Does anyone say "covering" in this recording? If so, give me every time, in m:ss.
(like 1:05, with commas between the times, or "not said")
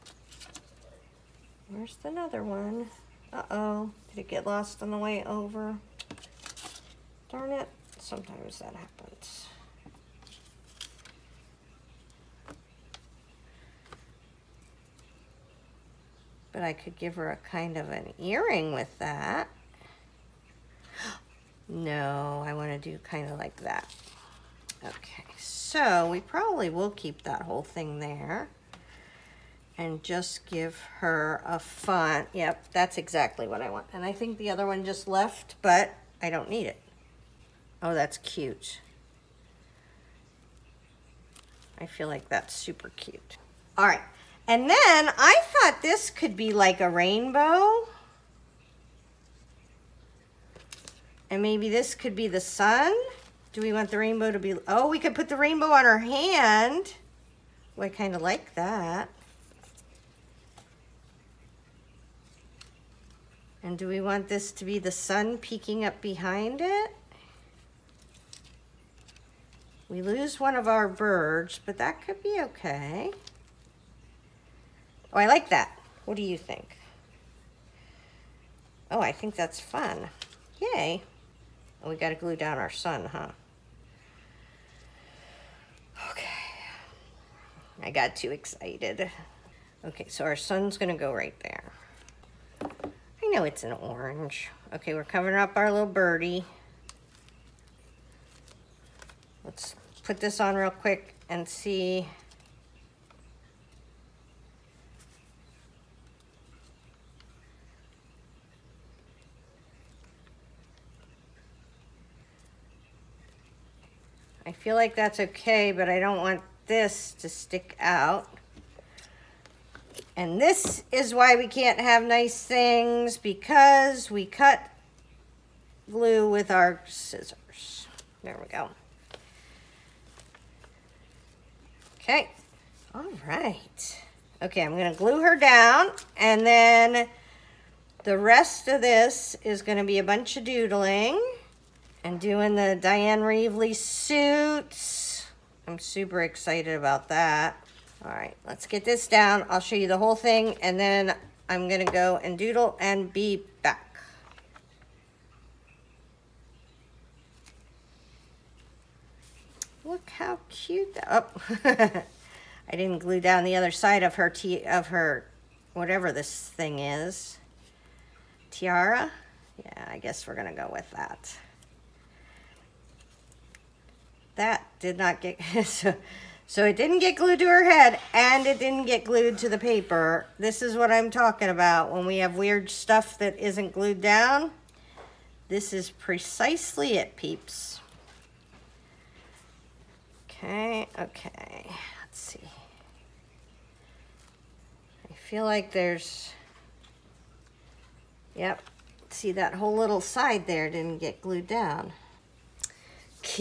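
1:35.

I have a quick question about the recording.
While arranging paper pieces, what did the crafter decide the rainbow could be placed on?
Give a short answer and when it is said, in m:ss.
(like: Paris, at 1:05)
Her hand, at 0:55.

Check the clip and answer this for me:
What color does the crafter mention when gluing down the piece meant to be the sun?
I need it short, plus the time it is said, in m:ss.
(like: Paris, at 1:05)
Orange, at 1:33.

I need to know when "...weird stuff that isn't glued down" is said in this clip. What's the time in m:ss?
3:02.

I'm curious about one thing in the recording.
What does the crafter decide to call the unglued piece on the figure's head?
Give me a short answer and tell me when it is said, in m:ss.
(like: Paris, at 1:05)
Tiara, at 2:48.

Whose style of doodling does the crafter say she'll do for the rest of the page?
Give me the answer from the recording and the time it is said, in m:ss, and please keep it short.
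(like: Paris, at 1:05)
Dyan Reaveley, at 2:22.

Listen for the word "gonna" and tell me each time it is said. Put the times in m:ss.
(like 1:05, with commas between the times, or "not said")
1:30, 2:14, 2:19, 2:31, 2:50.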